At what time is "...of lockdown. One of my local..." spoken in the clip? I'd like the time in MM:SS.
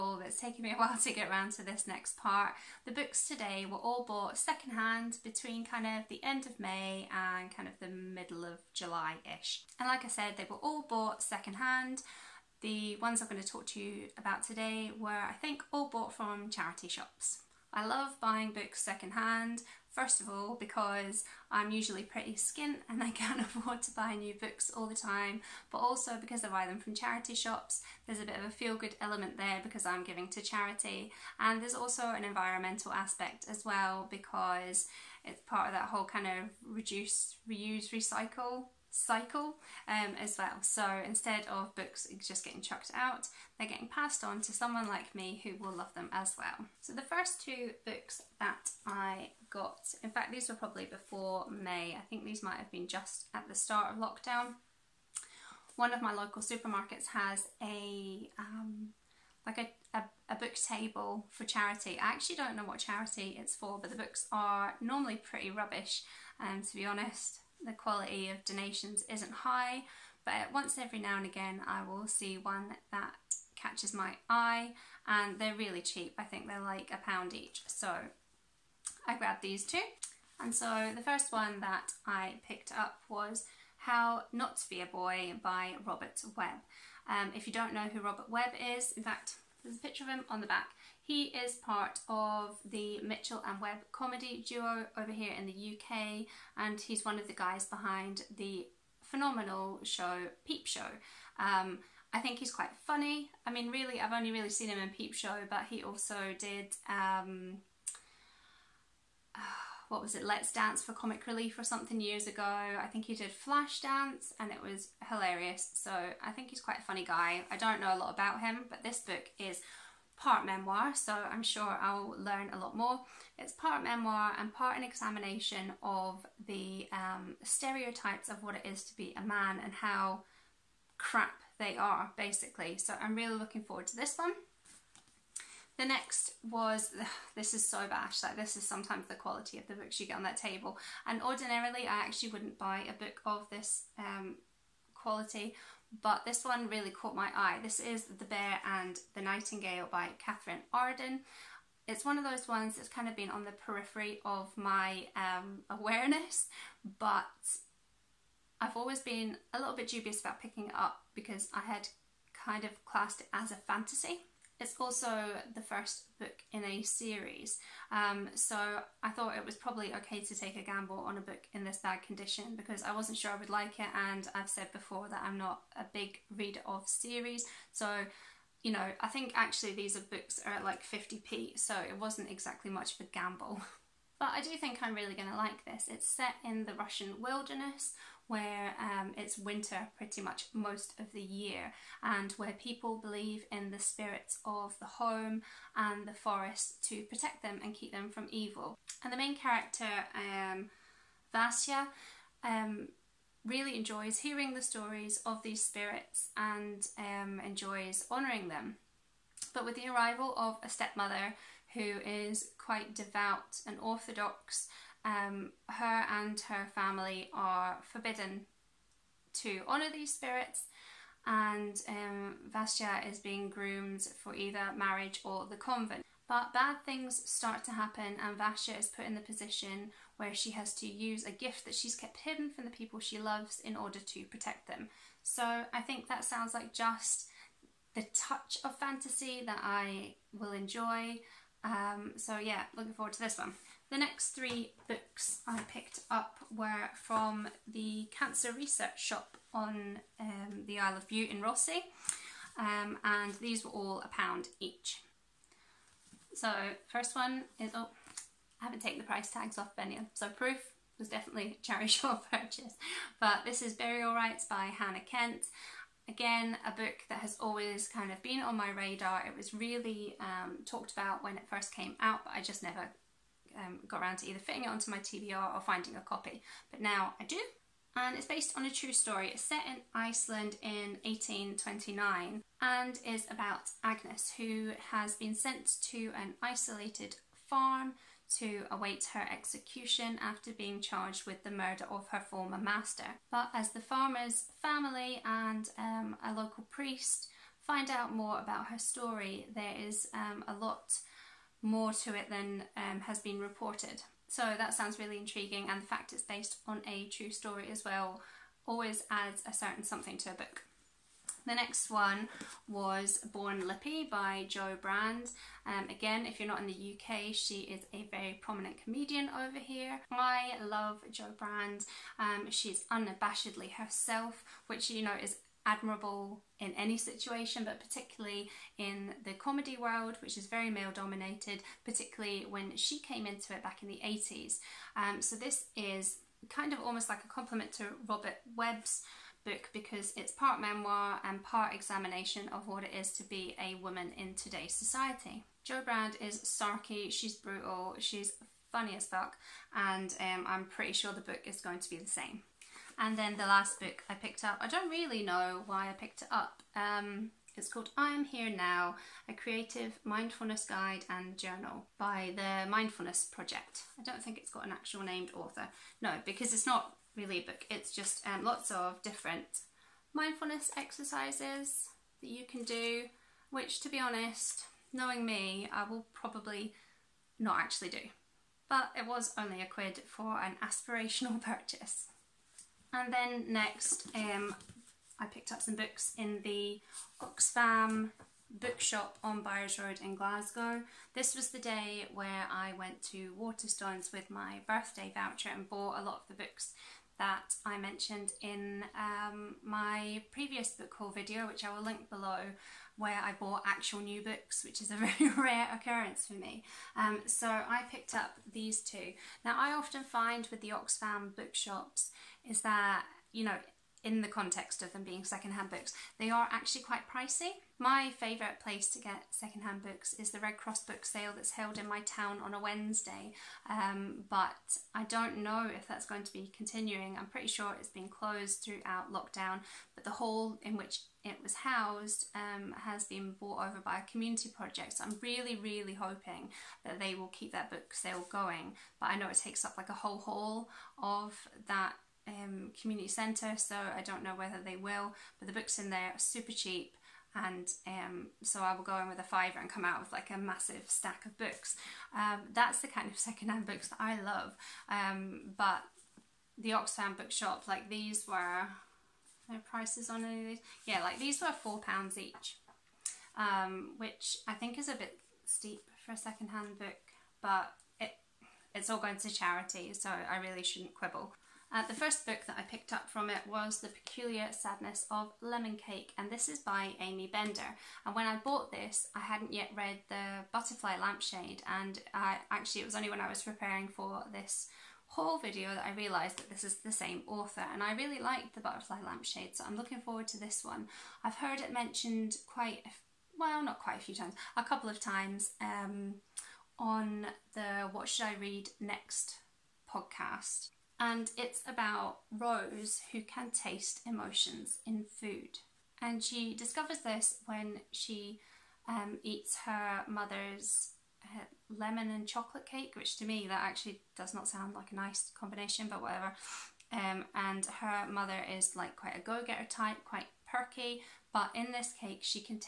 00:53.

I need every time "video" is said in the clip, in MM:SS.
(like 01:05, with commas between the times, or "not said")
06:41, 08:05.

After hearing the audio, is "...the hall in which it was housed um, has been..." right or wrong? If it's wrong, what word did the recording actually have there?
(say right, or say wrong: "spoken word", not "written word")
right.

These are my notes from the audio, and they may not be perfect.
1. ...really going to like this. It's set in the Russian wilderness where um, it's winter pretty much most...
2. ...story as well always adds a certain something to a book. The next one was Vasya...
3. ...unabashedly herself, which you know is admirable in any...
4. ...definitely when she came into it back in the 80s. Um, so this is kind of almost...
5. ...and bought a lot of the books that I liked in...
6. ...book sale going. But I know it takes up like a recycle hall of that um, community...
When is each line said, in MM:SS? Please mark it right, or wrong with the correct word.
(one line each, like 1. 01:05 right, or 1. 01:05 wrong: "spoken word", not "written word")
1. 03:04 right
2. 05:07 wrong: "Born", not "Vasya"
3. 05:22 right
4. 05:31 wrong: "particularly", not "definitely"
5. 06:35 wrong: "mentioned", not "liked"
6. 07:17 wrong: "whole", not "recycle".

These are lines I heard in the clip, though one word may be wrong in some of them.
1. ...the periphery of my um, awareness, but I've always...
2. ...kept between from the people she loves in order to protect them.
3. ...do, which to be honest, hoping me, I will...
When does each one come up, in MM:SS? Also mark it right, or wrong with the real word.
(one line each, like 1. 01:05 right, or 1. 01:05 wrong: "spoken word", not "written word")
1. 02:33 right
2. 03:51 wrong: "hidden", not "between"
3. 06:12 wrong: "knowing", not "hoping".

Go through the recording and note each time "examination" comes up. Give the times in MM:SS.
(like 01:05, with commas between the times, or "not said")
02:04, 05:41.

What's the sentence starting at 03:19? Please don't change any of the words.
And the main character, um, Vasya, um, really enjoys hearing the stories of these spirits and um, enjoys honouring them.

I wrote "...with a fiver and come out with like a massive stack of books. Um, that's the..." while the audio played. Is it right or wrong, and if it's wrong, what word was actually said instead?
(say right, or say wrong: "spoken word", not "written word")
right.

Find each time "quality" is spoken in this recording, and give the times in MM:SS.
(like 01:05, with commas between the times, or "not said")
01:07, 02:19, 02:24.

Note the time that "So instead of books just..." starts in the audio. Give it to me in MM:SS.
00:40.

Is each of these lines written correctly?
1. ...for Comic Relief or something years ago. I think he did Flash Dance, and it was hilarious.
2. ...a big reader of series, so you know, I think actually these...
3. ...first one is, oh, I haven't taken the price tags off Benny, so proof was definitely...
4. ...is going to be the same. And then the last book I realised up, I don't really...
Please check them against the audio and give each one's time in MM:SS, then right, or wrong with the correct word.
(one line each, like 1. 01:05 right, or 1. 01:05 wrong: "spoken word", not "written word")
1. 01:50 right
2. 02:55 right
3. 04:16 right
4. 05:51 wrong: "picked", not "realised".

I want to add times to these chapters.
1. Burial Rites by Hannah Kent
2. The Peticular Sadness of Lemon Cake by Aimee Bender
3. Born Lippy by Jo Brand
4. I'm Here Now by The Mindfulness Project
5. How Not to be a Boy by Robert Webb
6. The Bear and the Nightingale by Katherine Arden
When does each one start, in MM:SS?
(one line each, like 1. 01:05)
1. 04:15
2. 07:52
3. 05:11
4. 05:52
5. 01:20
6. 02:15.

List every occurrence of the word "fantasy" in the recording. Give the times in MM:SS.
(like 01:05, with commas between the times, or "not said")
02:43, 03:58.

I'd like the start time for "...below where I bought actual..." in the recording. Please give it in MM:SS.
06:42.